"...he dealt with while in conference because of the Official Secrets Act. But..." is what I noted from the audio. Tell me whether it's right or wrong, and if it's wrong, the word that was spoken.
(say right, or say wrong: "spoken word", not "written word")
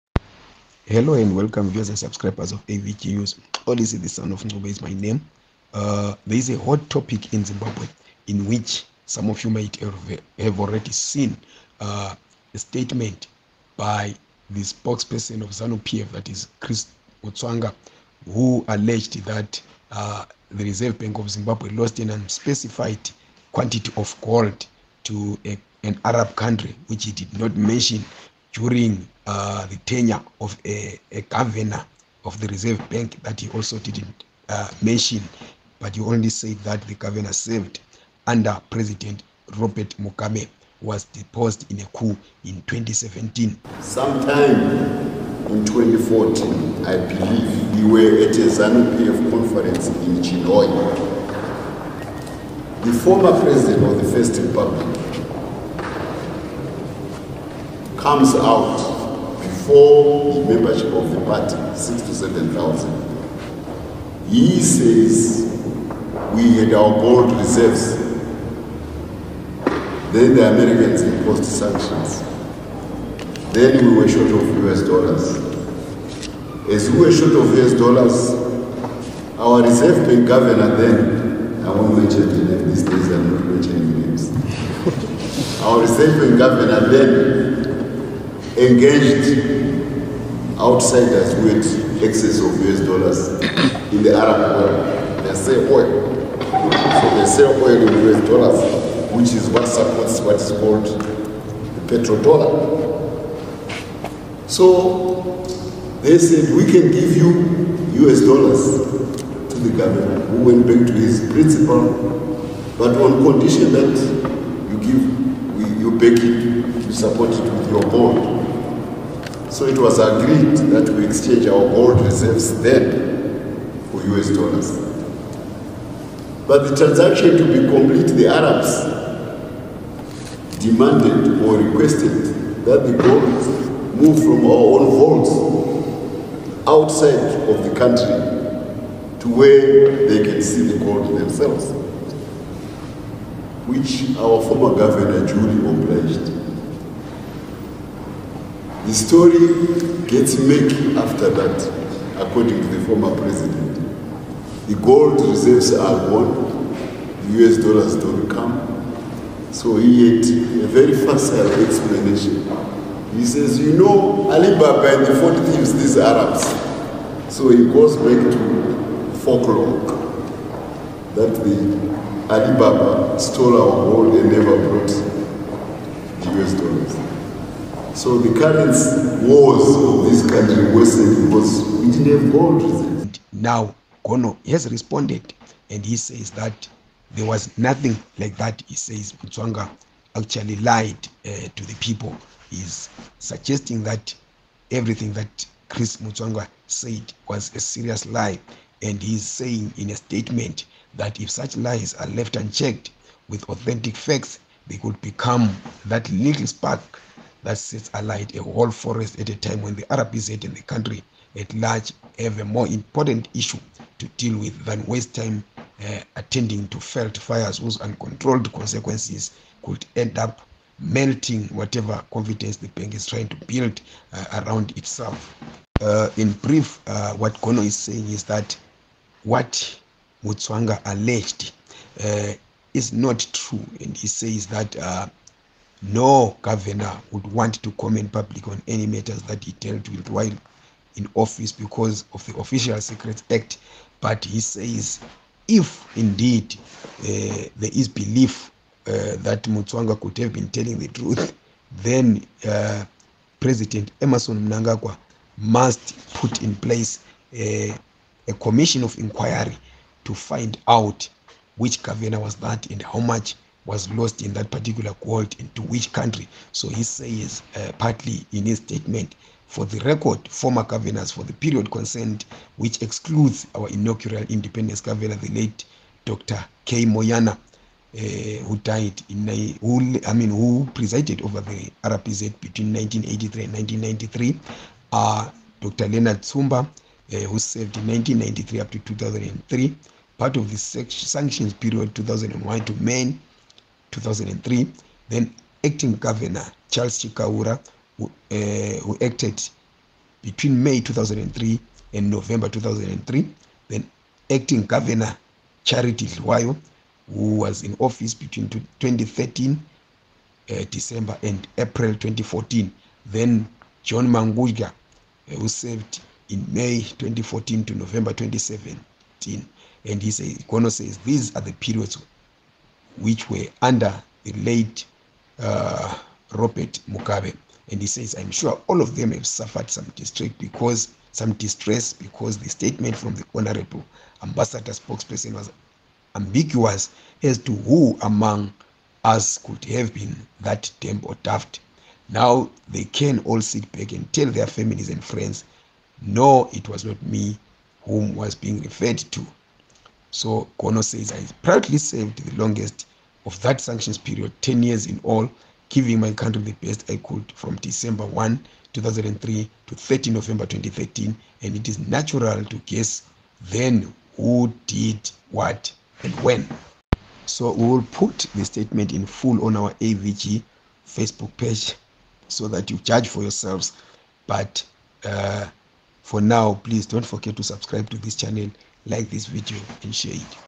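wrong: "office", not "conference".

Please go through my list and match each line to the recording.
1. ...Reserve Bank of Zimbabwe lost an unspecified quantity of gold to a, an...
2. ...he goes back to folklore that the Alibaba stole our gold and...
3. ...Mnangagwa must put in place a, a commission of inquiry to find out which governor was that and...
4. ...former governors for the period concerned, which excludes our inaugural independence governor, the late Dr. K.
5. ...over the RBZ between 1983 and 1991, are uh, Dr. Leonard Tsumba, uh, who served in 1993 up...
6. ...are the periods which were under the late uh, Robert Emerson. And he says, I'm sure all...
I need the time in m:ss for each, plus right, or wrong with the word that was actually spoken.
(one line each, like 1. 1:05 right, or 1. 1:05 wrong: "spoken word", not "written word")
1. 0:20 right
2. 2:47 right
3. 4:14 right
4. 4:30 right
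5. 4:41 wrong: "1993", not "1991"
6. 5:21 wrong: "Mugabe", not "Emerson".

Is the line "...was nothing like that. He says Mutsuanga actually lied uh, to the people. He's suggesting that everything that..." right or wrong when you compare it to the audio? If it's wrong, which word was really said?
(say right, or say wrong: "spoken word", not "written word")
right.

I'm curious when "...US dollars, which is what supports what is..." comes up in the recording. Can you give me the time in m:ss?
1:38.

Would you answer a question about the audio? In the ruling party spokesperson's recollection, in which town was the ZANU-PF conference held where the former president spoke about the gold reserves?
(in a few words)
Chinhoyi.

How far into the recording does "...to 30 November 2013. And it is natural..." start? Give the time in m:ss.
5:59.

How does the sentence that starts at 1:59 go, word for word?
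So it was agreed that we exchange our gold reserves then for US dollars.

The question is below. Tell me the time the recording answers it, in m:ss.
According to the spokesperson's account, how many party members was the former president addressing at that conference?
1:01.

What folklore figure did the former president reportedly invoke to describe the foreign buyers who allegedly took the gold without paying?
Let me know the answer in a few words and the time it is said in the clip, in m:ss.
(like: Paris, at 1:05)
Alibaba and the 40 thieves, at 2:44.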